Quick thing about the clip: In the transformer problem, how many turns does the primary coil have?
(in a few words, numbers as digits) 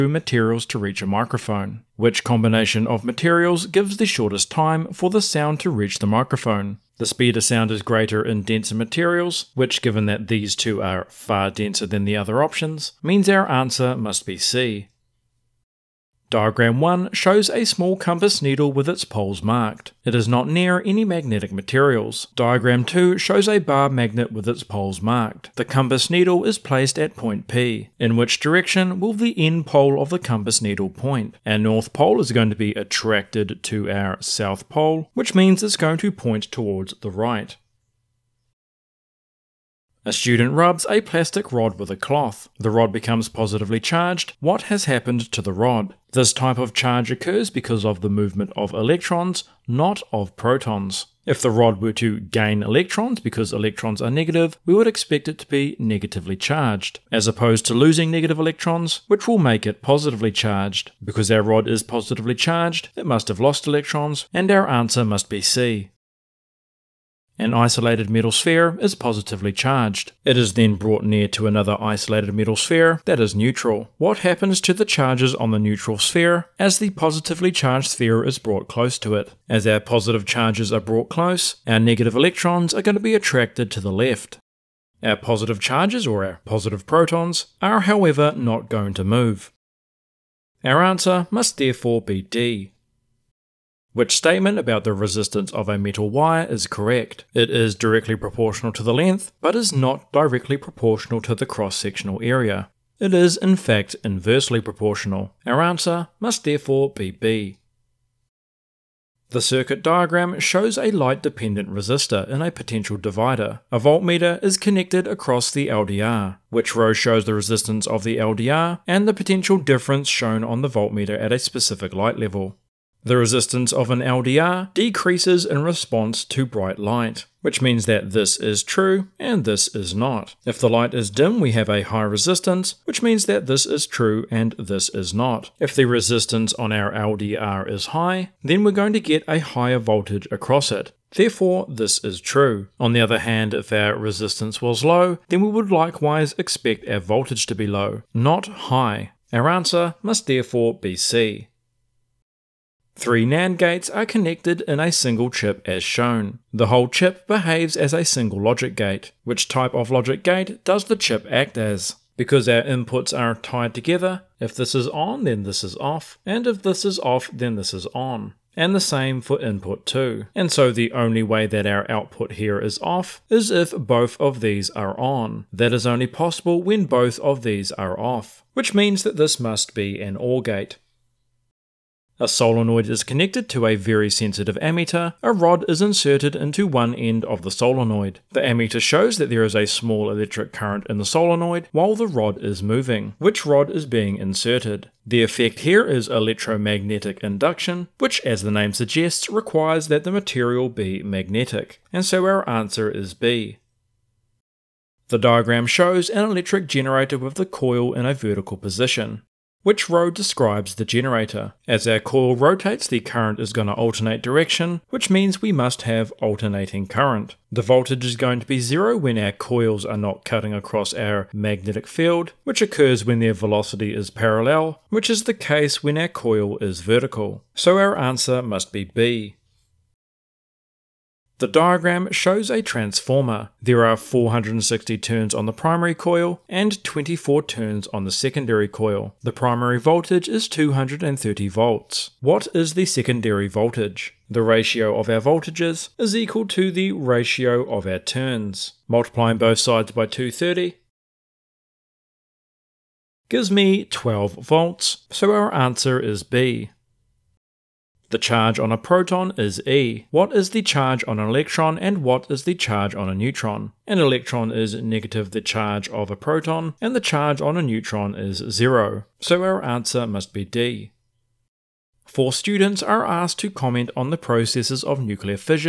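460.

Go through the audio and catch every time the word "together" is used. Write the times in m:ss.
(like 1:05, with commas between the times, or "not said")
2:43.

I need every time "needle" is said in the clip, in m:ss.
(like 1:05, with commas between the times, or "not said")
0:18, 0:26, 0:30.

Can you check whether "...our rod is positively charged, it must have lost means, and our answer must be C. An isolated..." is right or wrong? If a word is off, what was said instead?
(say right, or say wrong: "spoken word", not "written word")
wrong: "electrons", not "means".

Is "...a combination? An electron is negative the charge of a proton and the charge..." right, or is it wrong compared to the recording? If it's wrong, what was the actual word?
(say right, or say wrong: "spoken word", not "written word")
wrong: "neutron", not "combination".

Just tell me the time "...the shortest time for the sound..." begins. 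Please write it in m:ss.
0:03.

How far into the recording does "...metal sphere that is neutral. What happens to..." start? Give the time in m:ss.
1:12.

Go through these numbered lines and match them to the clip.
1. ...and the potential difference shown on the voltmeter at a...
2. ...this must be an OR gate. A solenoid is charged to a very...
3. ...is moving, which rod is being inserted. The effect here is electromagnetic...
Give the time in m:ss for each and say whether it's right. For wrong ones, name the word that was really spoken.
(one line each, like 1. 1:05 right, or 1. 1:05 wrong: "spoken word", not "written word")
1. 1:58 right
2. 2:59 wrong: "connected", not "charged"
3. 3:12 right.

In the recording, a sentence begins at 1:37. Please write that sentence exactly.
It is directly proportional to the length, but is not directly proportional to the cross-sectional area.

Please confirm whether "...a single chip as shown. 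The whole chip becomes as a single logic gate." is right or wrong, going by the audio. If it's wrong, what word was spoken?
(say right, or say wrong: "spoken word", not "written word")
wrong: "behaves", not "becomes".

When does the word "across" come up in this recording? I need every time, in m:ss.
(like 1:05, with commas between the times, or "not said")
1:55, 2:20, 3:40.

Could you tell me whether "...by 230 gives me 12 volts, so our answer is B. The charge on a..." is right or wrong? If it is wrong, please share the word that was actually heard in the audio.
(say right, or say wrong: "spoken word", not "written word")
right.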